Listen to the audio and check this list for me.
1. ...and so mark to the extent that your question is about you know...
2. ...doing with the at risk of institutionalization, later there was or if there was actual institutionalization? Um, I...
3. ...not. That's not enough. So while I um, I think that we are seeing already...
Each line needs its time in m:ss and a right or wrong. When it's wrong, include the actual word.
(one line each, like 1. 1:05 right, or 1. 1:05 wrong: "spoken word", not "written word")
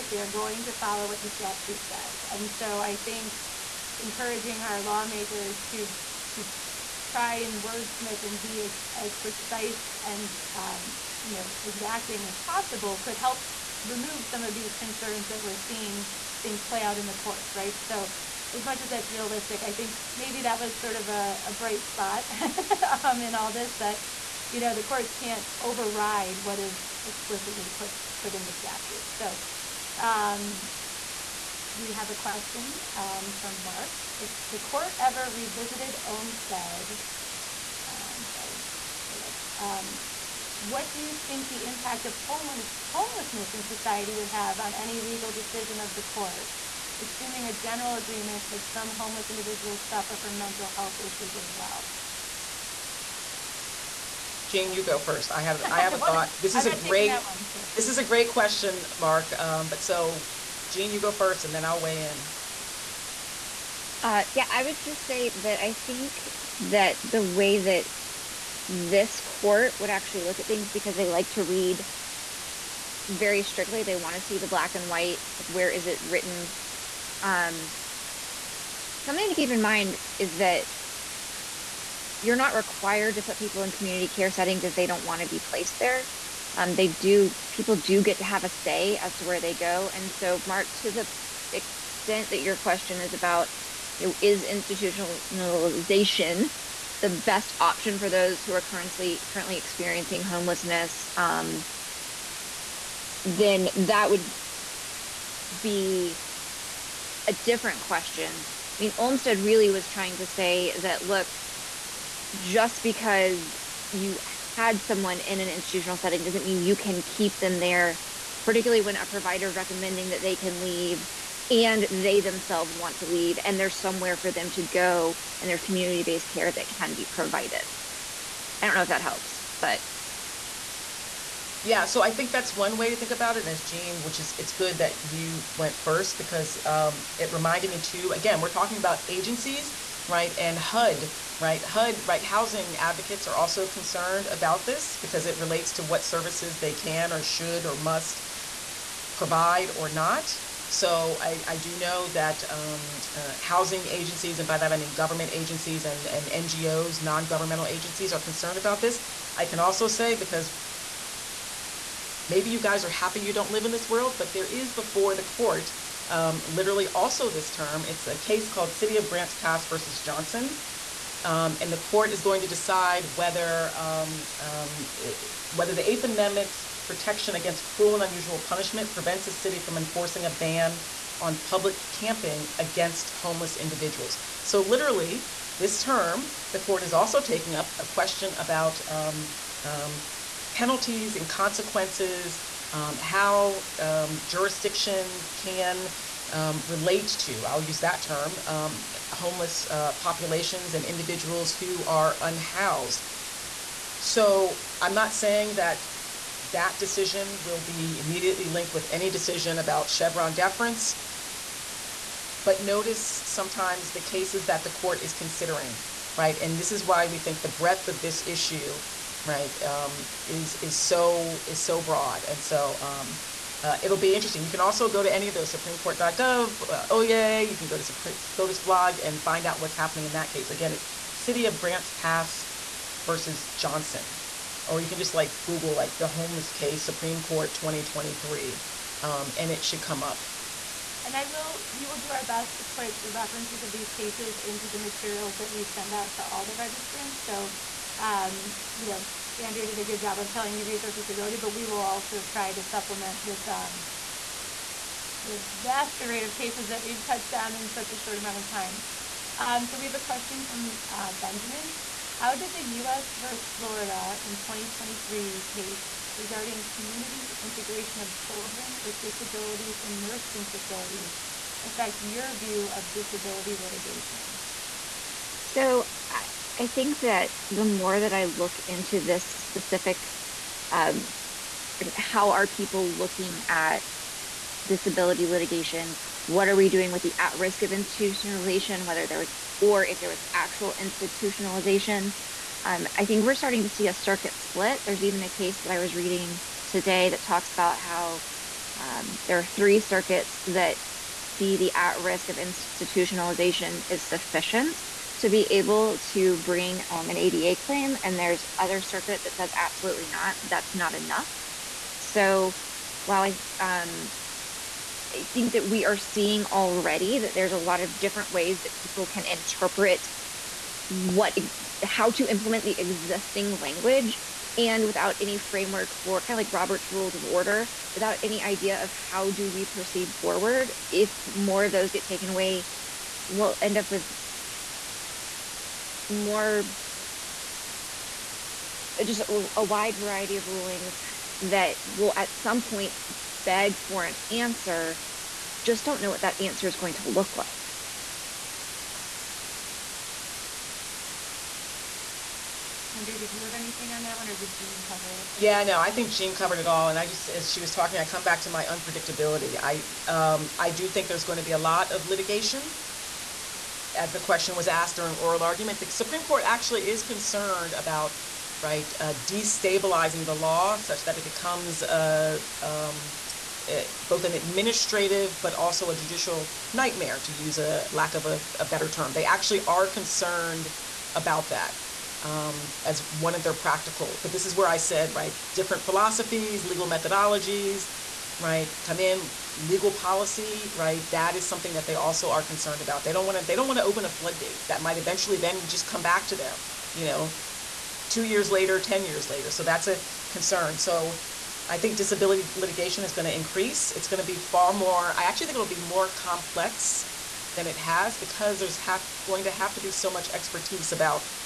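1. 1:29 right
2. 4:46 wrong: "whether", not "later"
3. 5:10 right.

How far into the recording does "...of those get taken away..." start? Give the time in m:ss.
5:31.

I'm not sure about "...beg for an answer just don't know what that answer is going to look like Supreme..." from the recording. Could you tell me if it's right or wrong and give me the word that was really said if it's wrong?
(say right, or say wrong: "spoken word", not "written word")
wrong: "Andrea", not "Supreme".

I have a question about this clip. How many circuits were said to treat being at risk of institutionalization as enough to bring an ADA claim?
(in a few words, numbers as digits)
3.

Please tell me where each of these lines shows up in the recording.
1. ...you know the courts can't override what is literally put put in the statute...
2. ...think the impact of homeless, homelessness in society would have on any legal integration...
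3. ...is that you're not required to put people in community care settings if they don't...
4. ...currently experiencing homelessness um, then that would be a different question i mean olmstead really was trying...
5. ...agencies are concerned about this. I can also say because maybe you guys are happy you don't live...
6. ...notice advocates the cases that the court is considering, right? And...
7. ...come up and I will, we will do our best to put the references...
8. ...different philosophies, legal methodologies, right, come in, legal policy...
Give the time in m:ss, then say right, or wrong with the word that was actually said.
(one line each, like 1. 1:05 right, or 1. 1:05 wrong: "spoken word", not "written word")
1. 0:24 wrong: "explicitly", not "literally"
2. 0:41 wrong: "decision", not "integration"
3. 1:20 right
4. 1:39 right
5. 2:37 right
6. 3:32 wrong: "sometimes", not "advocates"
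7. 3:59 right
8. 6:25 right.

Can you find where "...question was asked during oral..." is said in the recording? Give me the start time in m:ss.
6:04.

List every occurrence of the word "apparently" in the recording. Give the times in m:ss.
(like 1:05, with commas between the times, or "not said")
not said.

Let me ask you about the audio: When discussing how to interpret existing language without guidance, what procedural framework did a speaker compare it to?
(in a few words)
Robert's Rules of Order.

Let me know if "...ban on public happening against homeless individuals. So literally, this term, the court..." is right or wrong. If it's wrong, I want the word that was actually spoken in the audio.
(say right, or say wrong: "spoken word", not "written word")
wrong: "camping", not "happening".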